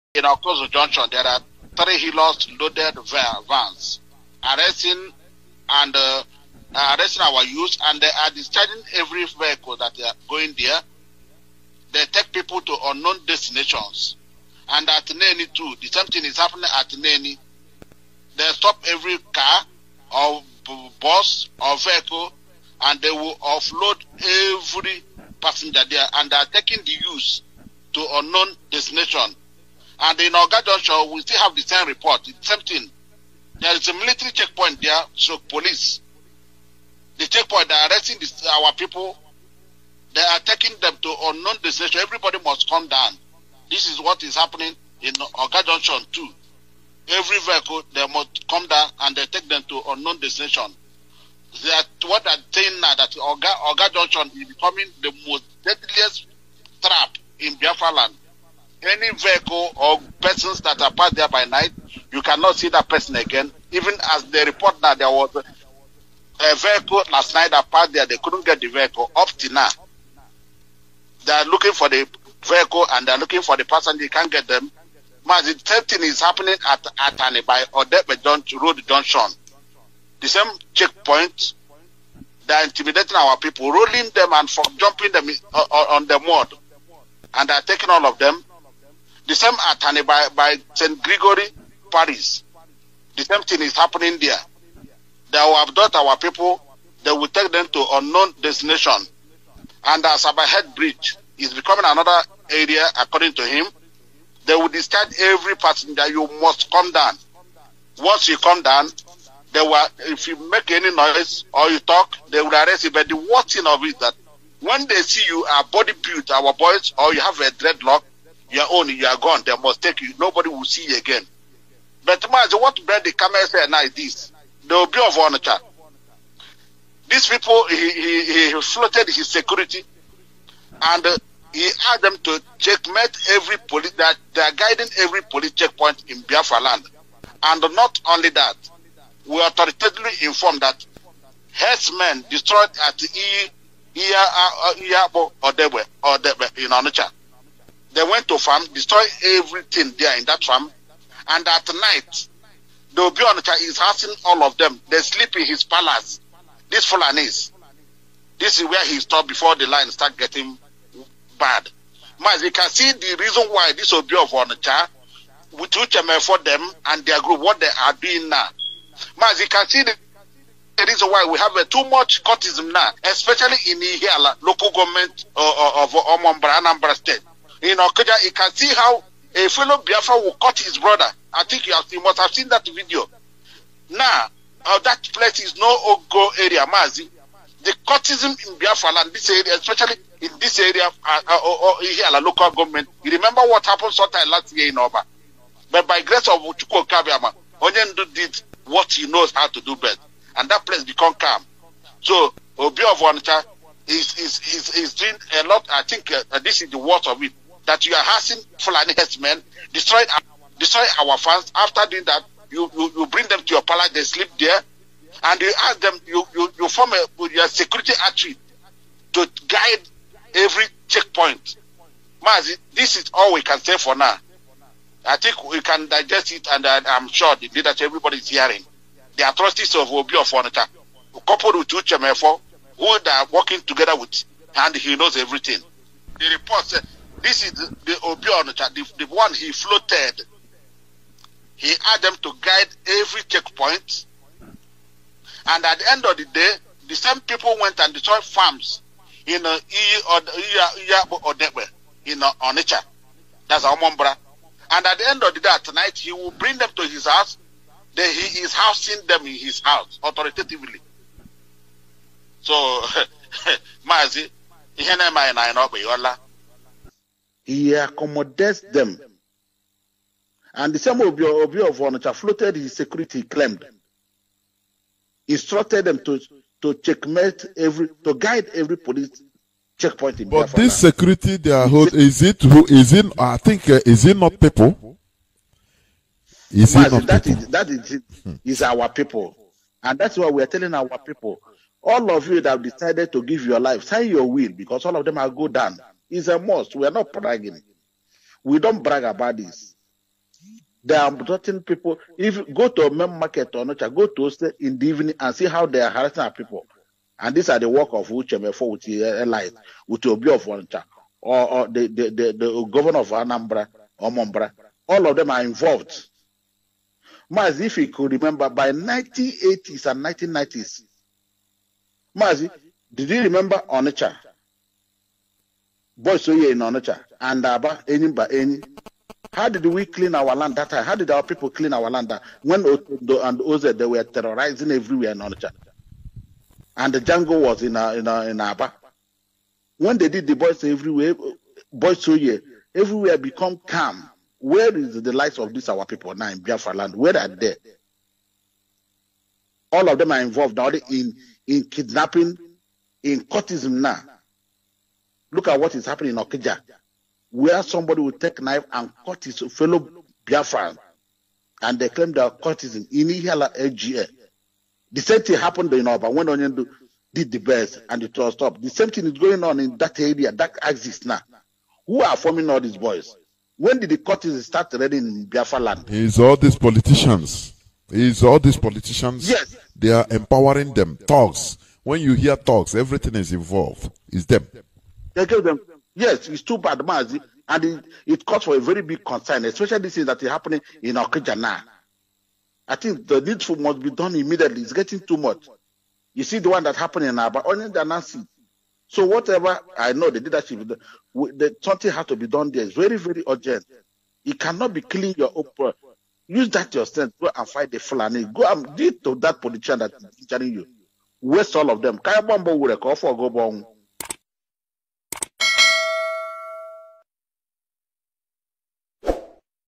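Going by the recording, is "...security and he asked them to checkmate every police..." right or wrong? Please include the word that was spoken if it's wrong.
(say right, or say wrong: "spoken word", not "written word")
right.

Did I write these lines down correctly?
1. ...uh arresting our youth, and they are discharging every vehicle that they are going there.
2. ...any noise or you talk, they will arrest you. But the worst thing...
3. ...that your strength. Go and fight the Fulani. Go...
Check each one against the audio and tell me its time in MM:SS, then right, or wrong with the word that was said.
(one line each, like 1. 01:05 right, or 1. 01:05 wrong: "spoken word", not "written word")
1. 00:06 right
2. 01:50 right
3. 06:46 right.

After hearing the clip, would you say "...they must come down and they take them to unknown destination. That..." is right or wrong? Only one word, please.
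right.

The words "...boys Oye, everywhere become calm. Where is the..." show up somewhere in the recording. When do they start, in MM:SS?
05:41.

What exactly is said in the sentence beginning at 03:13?
You remember what happened sometime last year in Oba?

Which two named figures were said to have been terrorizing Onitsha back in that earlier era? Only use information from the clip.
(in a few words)
Otondo and Oze.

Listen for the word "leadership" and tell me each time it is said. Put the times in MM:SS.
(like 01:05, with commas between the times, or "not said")
03:47, 06:40.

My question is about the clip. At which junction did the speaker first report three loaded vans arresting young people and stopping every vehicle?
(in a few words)
Okozo Junction.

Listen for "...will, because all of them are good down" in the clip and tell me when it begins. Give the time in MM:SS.
04:54.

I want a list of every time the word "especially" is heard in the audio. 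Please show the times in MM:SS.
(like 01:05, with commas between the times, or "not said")
02:53, 03:09, 06:29.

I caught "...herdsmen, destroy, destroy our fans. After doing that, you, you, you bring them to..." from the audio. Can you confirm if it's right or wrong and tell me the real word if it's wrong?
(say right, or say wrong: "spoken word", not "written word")
right.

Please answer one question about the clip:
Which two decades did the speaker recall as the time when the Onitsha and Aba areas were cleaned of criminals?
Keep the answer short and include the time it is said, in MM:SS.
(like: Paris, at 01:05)
1980s and 1990s, at 05:18.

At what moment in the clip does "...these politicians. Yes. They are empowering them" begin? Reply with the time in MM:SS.
06:18.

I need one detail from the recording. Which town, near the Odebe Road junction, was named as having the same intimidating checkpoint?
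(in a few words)
Atani.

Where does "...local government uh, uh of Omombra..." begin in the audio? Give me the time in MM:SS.
02:54.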